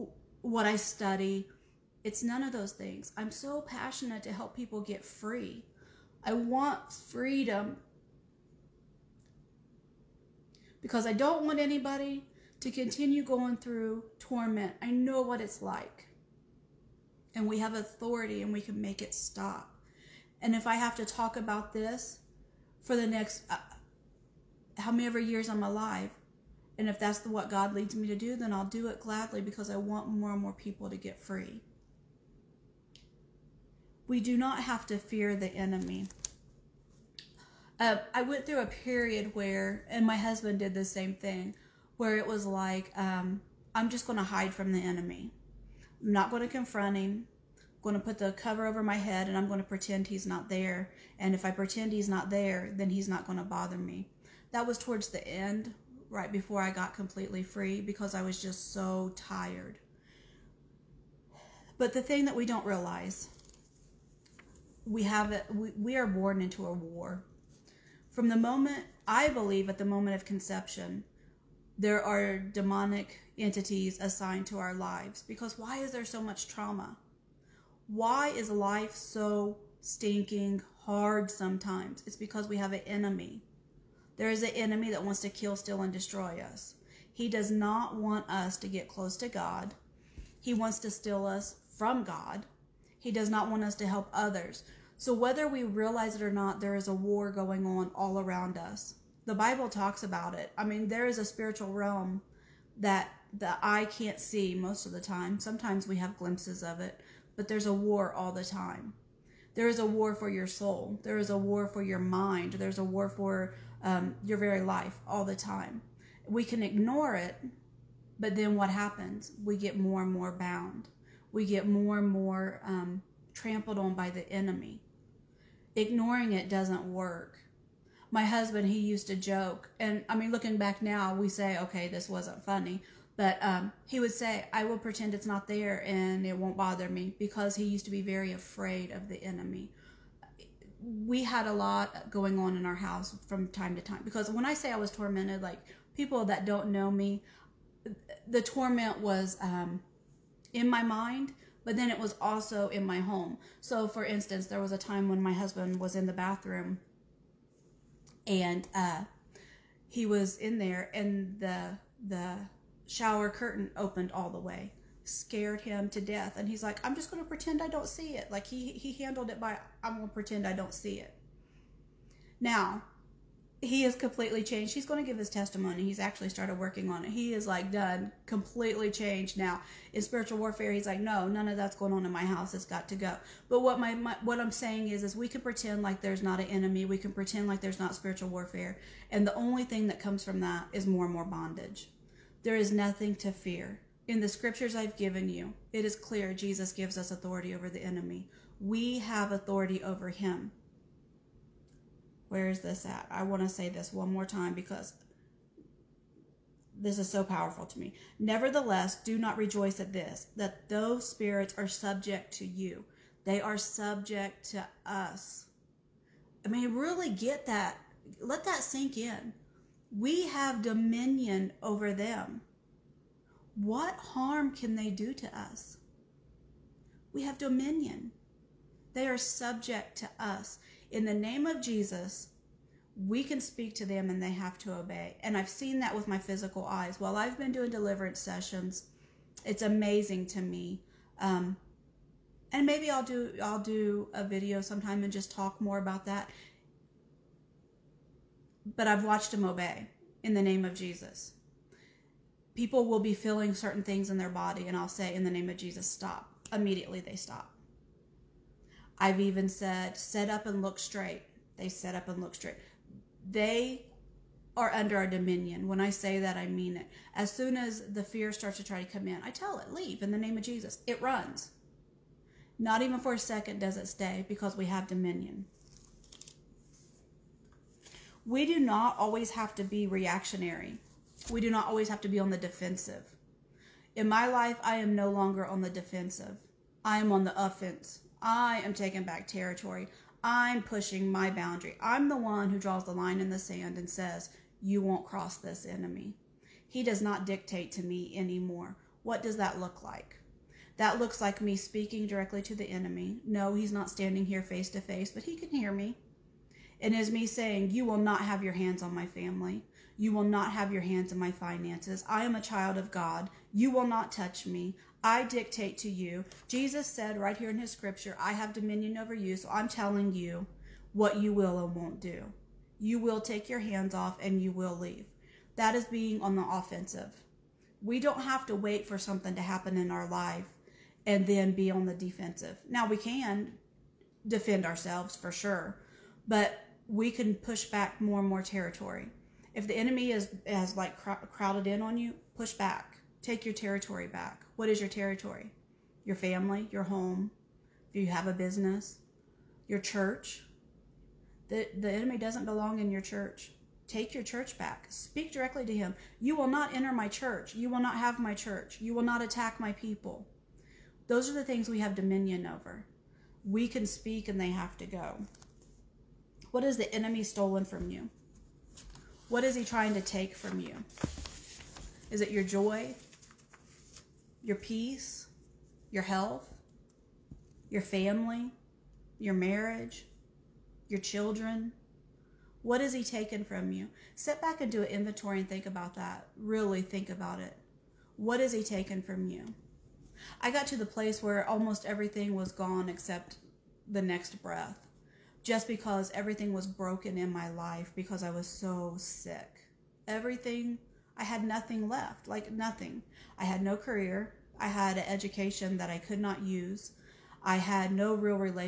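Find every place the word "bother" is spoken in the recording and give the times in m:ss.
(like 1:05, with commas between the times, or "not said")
0:53, 2:16.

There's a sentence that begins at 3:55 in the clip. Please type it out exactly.
And I've seen that with my physical eyes.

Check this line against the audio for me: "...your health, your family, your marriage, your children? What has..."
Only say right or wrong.
right.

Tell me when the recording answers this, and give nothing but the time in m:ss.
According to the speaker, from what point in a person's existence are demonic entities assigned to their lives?
1:09.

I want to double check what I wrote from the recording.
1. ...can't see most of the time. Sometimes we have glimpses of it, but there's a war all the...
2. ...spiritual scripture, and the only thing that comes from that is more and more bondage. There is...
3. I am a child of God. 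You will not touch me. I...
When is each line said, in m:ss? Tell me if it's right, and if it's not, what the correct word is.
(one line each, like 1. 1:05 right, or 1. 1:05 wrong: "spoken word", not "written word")
1. 1:43 right
2. 3:07 wrong: "warfare", not "scripture"
3. 5:12 right.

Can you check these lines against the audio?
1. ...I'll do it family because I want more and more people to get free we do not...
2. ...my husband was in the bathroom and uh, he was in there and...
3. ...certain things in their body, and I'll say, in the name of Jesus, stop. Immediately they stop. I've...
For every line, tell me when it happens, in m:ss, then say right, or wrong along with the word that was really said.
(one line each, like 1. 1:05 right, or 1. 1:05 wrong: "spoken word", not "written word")
1. 0:28 wrong: "gladly", not "family"
2. 2:35 right
3. 4:13 right.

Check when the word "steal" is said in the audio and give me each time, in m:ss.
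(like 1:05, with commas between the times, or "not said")
1:25, 1:30.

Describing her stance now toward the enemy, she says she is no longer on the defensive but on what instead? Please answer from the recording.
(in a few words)
The offense.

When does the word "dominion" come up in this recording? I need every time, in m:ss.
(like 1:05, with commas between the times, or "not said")
3:40, 3:47, 4:25, 4:34, 5:18, 6:01.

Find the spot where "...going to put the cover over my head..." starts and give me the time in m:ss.
0:47.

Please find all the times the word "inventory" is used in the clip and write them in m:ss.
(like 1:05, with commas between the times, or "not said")
6:24.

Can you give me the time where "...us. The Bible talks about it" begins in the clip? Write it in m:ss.
1:38.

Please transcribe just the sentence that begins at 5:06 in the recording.
It is me saying, You will not have your hands on my family.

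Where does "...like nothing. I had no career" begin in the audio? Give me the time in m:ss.
6:42.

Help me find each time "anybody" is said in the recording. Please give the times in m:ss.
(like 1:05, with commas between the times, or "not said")
0:11.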